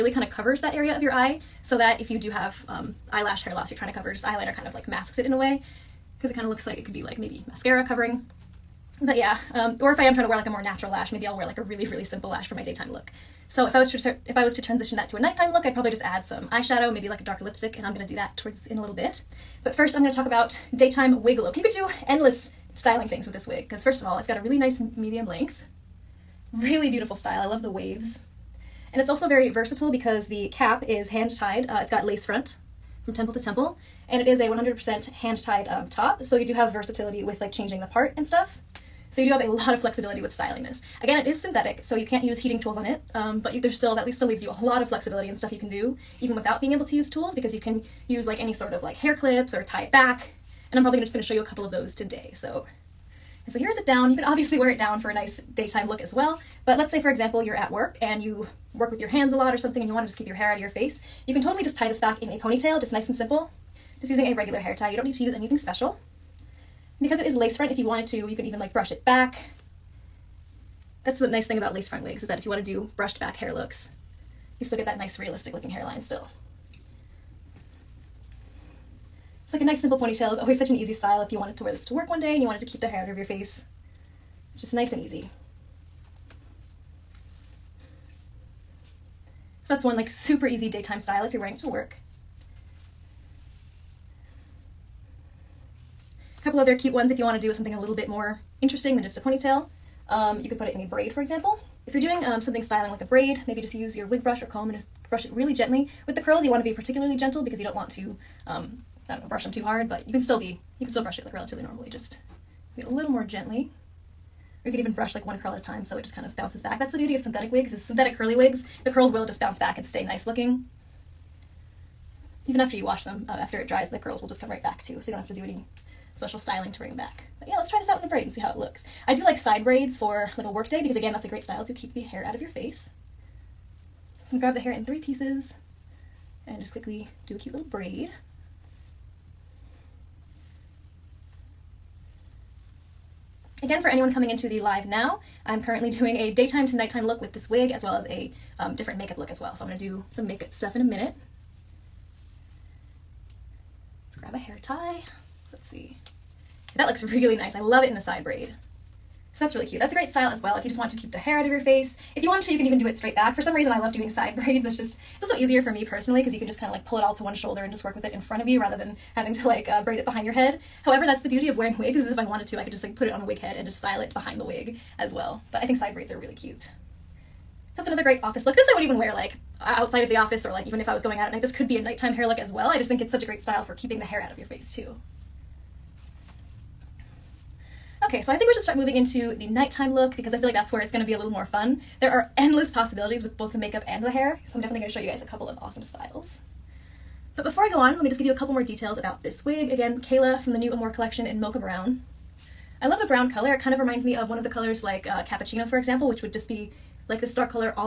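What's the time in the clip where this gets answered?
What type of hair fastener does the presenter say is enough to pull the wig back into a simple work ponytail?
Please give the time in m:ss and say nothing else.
1:04.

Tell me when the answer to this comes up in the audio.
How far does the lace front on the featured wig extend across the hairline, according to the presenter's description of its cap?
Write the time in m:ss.
0:33.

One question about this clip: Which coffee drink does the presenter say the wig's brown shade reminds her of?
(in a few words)
Cappuccino.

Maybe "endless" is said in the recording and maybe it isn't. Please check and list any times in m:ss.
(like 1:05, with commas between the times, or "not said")
0:22, 3:12.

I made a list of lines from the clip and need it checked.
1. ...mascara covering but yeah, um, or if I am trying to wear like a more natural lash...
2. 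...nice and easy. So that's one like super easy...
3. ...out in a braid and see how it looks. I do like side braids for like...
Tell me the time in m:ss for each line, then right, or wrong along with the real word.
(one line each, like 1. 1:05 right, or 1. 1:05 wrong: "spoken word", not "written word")
1. 0:07 right
2. 1:24 right
3. 2:07 right.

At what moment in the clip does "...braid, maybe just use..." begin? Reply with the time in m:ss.
1:43.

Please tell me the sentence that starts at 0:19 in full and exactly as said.
But first, I'm gonna talk about daytime wig look.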